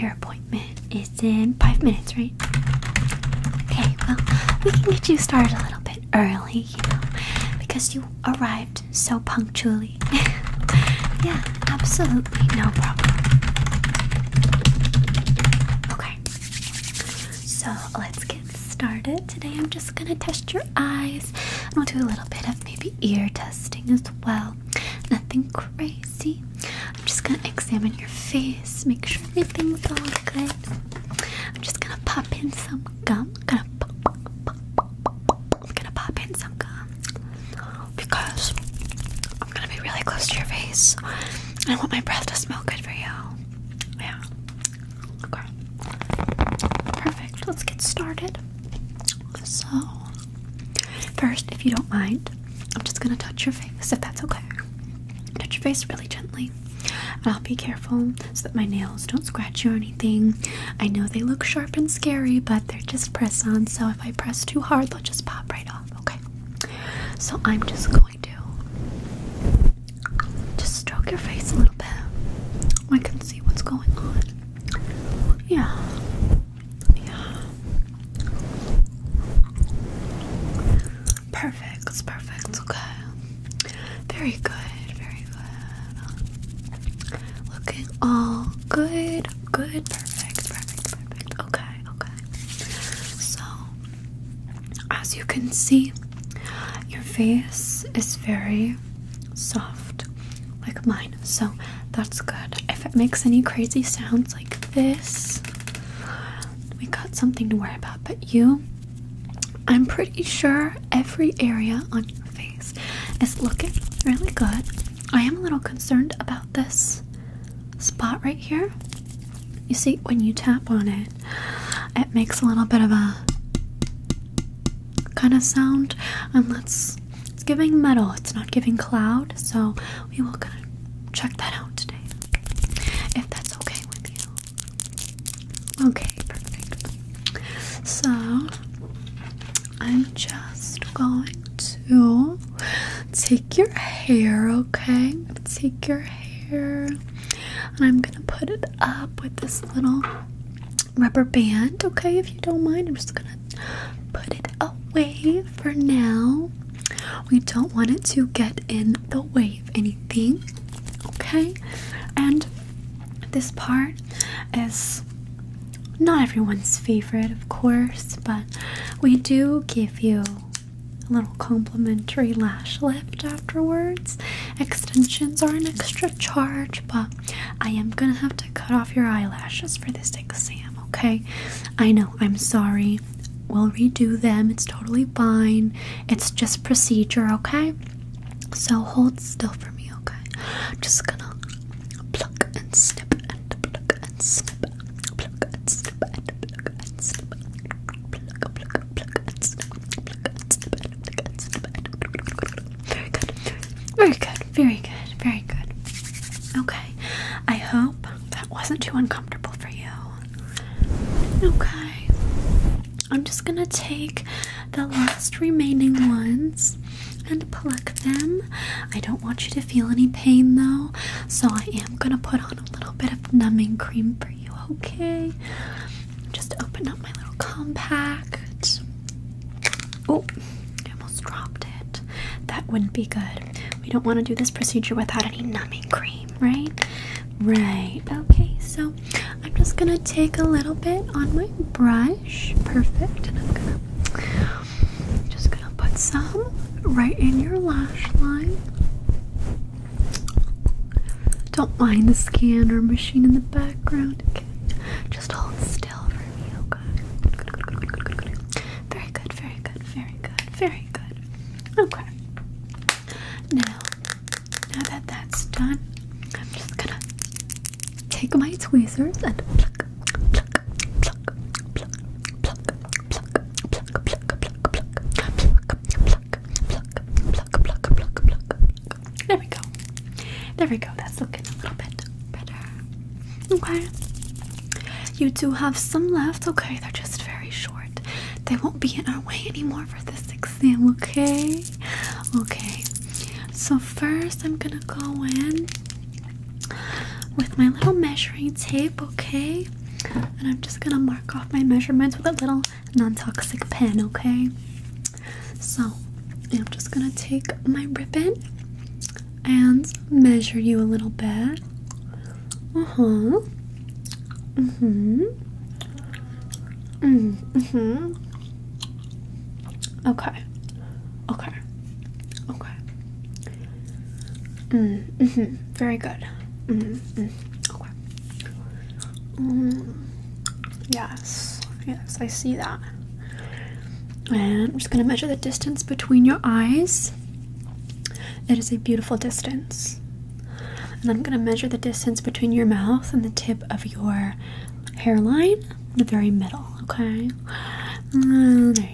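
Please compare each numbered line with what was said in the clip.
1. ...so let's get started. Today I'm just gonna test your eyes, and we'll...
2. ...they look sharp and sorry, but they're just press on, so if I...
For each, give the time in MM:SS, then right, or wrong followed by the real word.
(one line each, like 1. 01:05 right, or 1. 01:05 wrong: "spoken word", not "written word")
1. 00:17 right
2. 01:01 wrong: "scary", not "sorry".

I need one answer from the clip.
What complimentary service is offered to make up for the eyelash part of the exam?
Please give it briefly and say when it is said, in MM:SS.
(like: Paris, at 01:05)
lash lift, at 02:52.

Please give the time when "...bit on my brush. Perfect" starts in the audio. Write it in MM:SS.
04:00.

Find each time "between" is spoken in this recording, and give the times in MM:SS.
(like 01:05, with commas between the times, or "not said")
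05:35, 05:42.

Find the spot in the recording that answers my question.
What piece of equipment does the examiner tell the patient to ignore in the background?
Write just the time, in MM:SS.
04:12.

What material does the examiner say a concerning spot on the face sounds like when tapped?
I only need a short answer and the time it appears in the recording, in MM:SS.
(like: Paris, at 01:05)
metal, at 02:07.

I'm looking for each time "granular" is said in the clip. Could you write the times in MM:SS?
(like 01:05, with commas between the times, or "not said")
not said.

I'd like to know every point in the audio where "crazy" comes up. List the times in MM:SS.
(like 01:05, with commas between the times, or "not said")
00:25, 01:43.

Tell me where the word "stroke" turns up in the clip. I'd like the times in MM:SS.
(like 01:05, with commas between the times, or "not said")
01:10.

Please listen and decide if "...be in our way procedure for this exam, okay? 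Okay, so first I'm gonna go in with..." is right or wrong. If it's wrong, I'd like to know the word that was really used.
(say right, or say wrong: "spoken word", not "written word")
wrong: "anymore", not "procedure".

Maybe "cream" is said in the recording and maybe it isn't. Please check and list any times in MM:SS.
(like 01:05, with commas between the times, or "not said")
03:43, 03:55.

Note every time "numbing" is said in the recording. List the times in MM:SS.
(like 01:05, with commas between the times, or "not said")
03:43, 03:55.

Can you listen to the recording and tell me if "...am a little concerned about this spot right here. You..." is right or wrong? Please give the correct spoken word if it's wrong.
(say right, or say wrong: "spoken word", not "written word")
right.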